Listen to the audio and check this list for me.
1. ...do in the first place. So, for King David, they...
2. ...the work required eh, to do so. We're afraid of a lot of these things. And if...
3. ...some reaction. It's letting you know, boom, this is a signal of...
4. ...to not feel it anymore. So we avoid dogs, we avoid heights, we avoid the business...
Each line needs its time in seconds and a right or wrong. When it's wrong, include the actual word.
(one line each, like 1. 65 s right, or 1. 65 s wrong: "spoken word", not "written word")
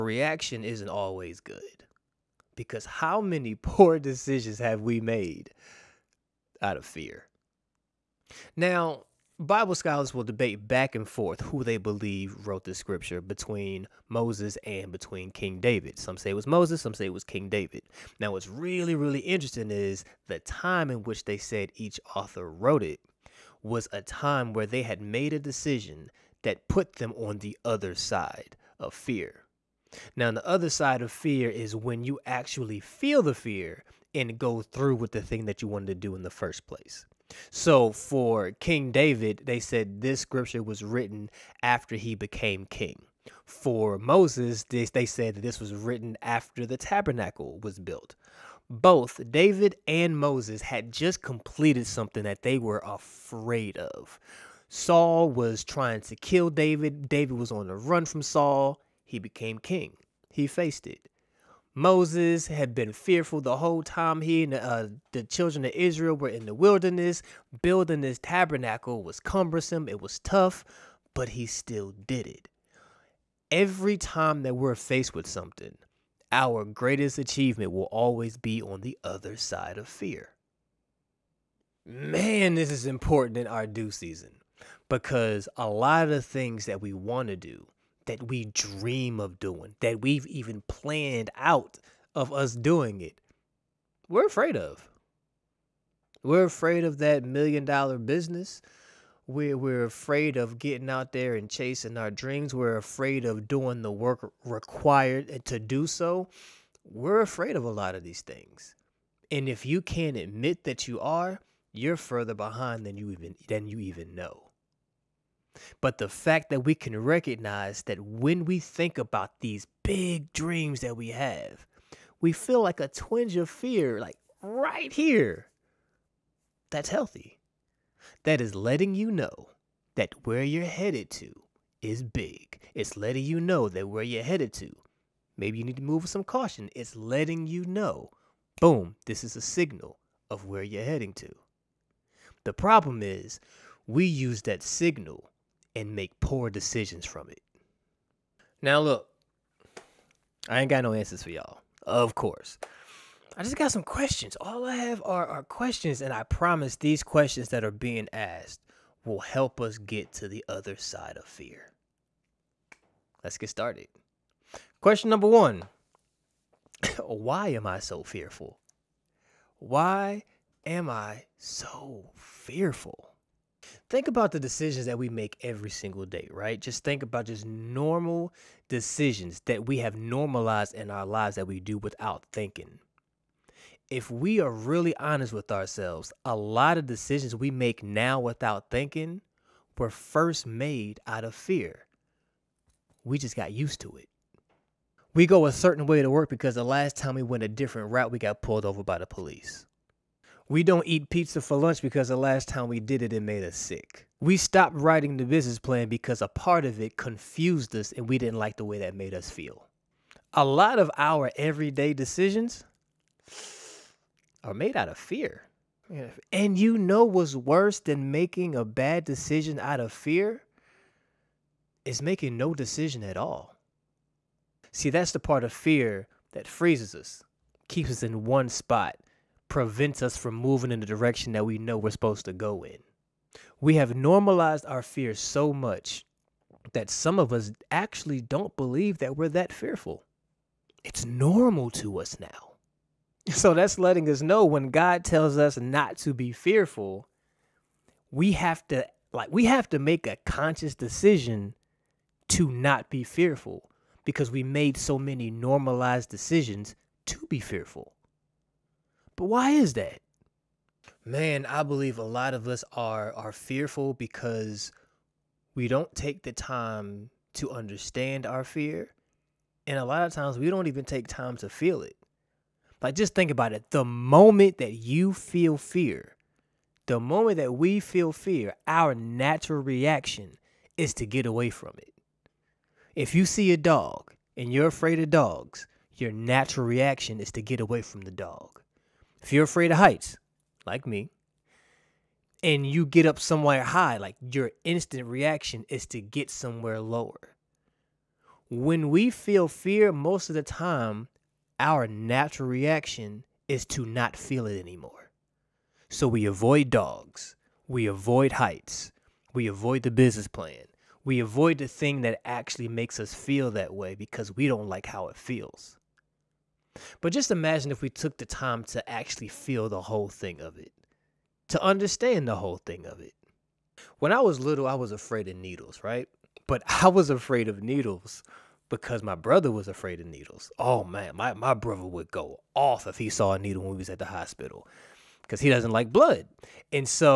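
1. 35 s right
2. 103 s right
3. 136 s wrong: "caution", not "reaction"
4. 303 s right.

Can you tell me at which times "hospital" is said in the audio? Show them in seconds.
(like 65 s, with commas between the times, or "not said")
334 s.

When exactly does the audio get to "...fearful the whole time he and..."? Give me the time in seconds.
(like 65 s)
62 s.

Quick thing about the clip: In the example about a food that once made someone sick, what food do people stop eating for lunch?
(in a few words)
pizza.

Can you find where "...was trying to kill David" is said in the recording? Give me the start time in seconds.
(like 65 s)
55 s.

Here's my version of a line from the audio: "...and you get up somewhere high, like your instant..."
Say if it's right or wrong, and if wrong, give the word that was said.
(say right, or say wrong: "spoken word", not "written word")
right.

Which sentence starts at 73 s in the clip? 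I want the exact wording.
Every time that we're faced with something, our greatest achievement will always be on the other side of fear.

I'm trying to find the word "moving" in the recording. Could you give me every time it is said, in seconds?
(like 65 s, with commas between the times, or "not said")
230 s.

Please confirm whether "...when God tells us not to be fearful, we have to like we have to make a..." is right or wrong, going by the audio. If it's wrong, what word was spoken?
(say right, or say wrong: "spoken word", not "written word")
right.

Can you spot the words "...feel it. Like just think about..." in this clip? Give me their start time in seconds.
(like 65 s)
271 s.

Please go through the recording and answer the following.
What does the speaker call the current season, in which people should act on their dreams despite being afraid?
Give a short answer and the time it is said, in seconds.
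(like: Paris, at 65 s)
Do Season, at 83 s.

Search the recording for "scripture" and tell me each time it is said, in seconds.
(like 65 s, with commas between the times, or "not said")
12 s, 40 s.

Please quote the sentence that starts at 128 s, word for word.
That is letting you know that where you're headed to is big.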